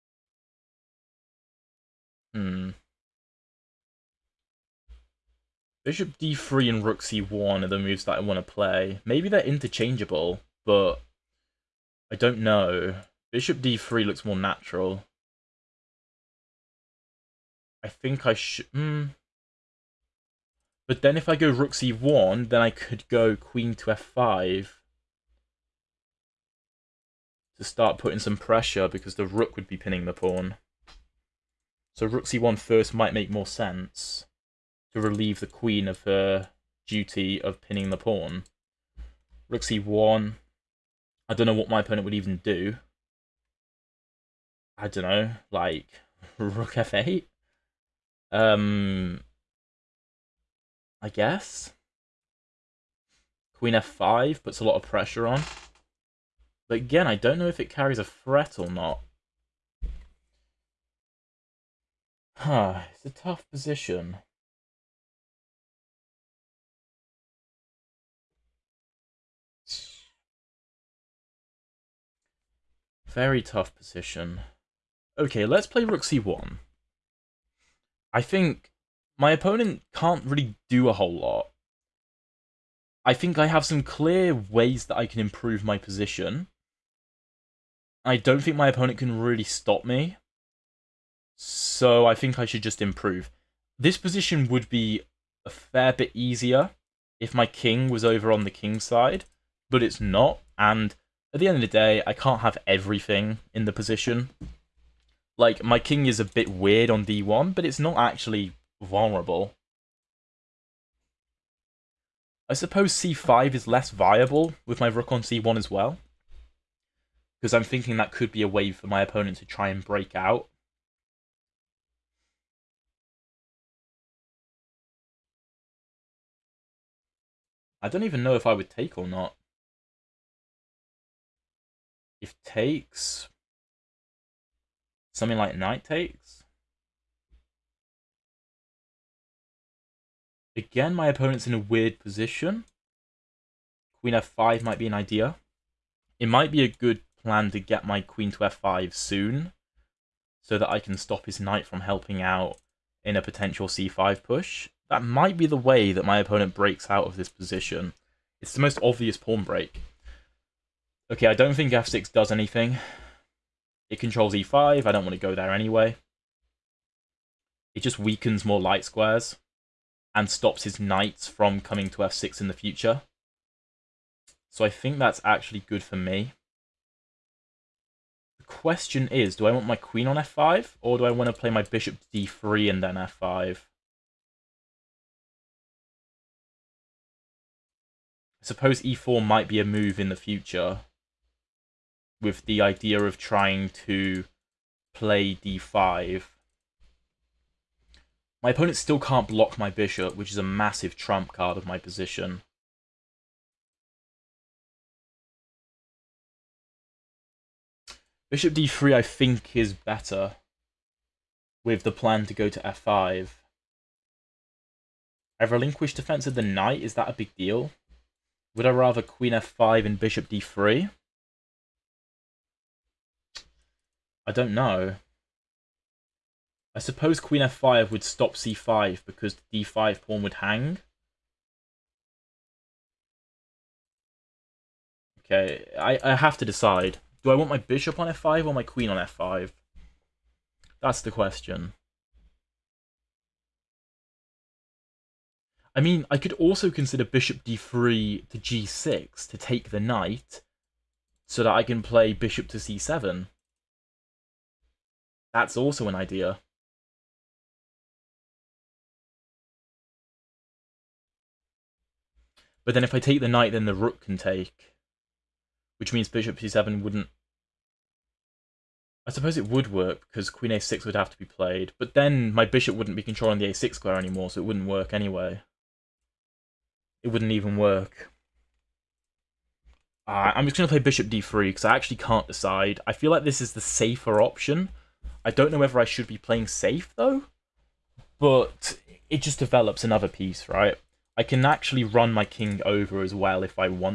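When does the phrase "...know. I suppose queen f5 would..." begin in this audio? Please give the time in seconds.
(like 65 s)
224 s.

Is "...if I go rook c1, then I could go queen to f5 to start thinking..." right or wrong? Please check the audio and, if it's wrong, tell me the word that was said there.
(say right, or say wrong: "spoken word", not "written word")
wrong: "putting", not "thinking".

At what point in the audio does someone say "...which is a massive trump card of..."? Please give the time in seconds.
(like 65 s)
200 s.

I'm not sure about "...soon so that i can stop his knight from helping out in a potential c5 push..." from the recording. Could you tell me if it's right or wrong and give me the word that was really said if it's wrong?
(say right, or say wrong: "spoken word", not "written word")
right.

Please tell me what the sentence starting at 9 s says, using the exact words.
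Maybe they're interchangeable, but I don't know.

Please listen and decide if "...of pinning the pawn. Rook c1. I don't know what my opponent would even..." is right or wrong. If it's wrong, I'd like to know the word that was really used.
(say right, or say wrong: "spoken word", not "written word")
right.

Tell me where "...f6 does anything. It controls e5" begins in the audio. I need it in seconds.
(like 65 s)
161 s.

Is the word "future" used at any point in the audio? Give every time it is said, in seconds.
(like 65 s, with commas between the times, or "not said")
172 s, 190 s.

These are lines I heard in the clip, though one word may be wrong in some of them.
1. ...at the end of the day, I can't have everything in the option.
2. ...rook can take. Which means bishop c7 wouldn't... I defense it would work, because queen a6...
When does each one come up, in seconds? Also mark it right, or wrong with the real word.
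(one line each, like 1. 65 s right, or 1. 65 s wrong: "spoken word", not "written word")
1. 101 s wrong: "position", not "option"
2. 263 s wrong: "suppose", not "defense".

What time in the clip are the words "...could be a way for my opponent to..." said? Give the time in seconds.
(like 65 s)
118 s.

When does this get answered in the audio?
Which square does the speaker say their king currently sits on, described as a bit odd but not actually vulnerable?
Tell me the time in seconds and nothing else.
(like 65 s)
107 s.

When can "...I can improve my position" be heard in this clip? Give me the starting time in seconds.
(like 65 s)
84 s.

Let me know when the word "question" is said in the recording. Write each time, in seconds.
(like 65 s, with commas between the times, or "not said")
178 s, 241 s.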